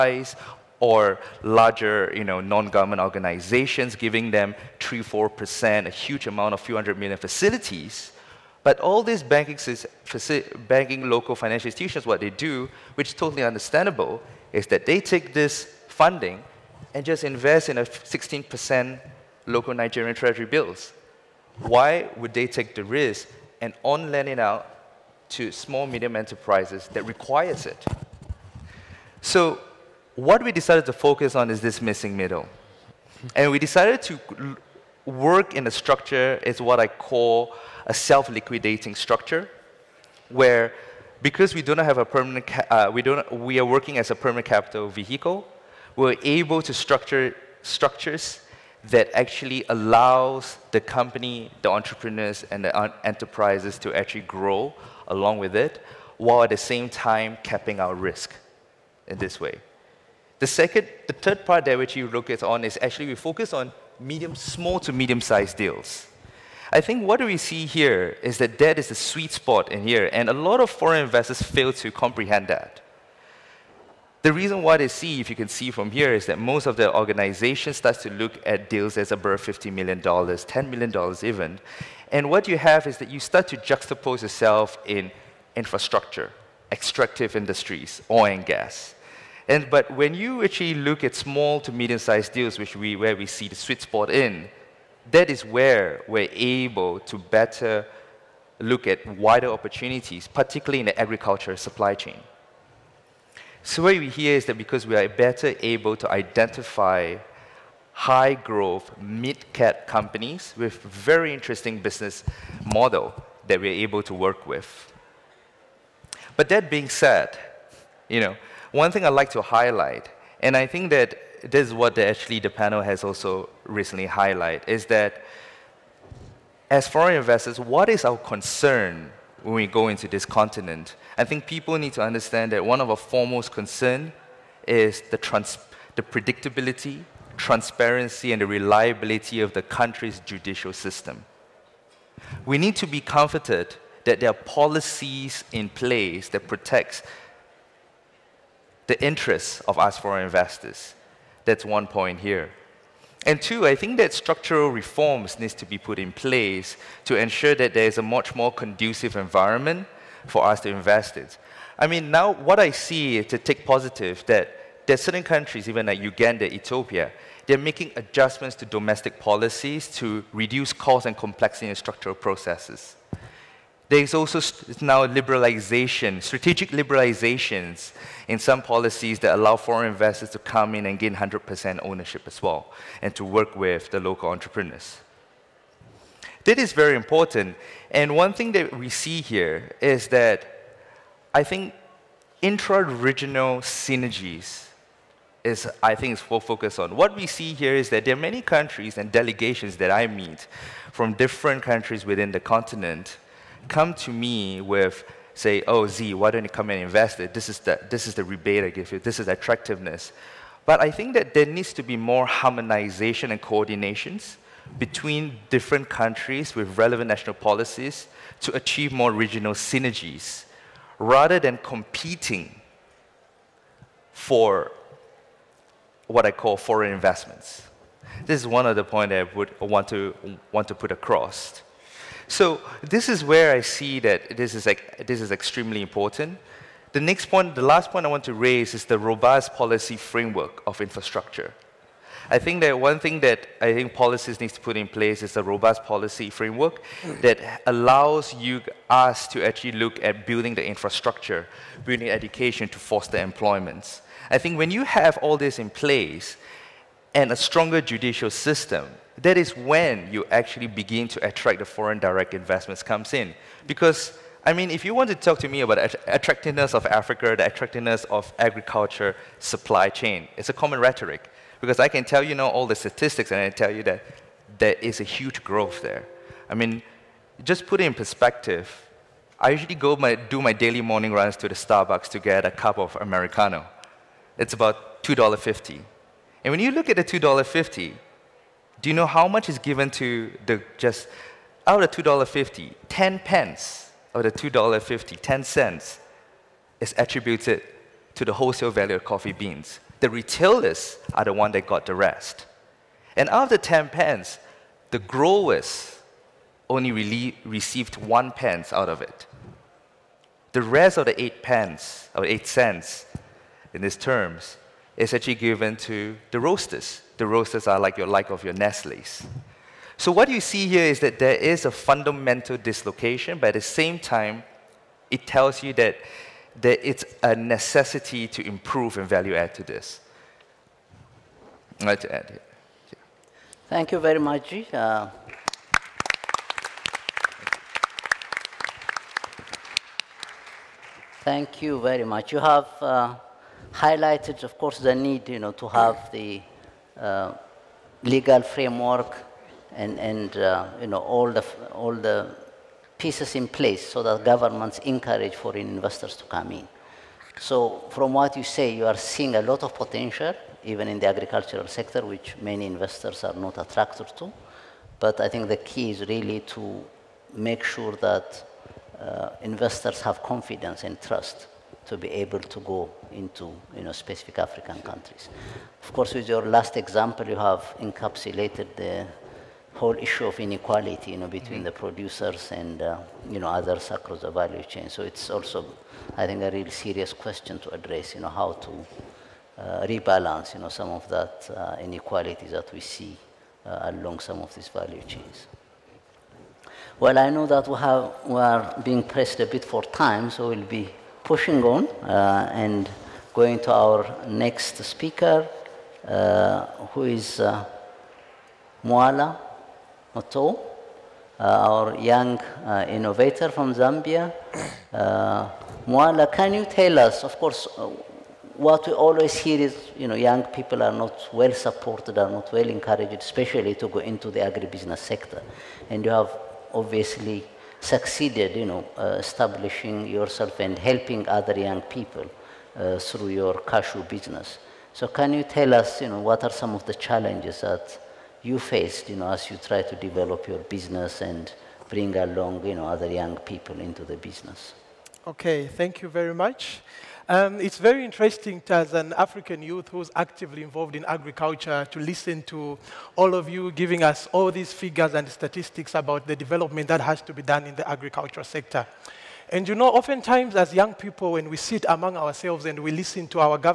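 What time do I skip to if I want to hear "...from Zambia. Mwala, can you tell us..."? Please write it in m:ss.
6:53.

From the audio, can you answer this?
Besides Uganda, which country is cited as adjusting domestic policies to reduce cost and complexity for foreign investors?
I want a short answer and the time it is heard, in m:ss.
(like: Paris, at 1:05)
Ethiopia, at 2:46.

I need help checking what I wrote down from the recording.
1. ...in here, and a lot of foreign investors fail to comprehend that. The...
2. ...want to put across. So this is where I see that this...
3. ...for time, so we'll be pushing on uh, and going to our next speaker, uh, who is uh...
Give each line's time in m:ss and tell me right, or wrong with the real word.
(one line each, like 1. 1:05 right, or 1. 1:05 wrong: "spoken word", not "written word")
1. 1:09 right
2. 3:50 right
3. 6:39 right.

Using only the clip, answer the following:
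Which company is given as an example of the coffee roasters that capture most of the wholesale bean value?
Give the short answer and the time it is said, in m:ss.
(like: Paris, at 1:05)
Nestle, at 5:18.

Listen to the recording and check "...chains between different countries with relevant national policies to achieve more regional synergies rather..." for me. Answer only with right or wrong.
wrong.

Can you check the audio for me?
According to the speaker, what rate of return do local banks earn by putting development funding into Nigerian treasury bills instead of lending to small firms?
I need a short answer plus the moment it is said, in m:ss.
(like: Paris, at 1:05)
16%, at 0:17.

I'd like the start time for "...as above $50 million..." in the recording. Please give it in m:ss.
1:18.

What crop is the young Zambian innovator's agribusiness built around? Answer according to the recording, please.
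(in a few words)
cashew.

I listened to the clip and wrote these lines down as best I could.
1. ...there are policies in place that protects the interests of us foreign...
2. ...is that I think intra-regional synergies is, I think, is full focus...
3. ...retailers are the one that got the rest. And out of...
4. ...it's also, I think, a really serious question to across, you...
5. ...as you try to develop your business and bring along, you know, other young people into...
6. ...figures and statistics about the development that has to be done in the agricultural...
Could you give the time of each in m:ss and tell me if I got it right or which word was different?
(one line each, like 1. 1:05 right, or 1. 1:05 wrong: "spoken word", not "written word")
1. 2:24 right
2. 3:09 right
3. 5:00 right
4. 6:25 wrong: "address", not "across"
5. 7:19 right
6. 7:34 right.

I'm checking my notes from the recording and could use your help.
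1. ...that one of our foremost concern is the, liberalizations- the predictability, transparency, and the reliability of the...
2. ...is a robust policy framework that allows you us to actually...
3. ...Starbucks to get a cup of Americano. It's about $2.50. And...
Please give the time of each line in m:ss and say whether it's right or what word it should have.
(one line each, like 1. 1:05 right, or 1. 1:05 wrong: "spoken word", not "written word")
1. 2:12 wrong: "trans", not "liberalizations"
2. 4:05 right
3. 4:41 right.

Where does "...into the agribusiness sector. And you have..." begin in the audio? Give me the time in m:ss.
7:03.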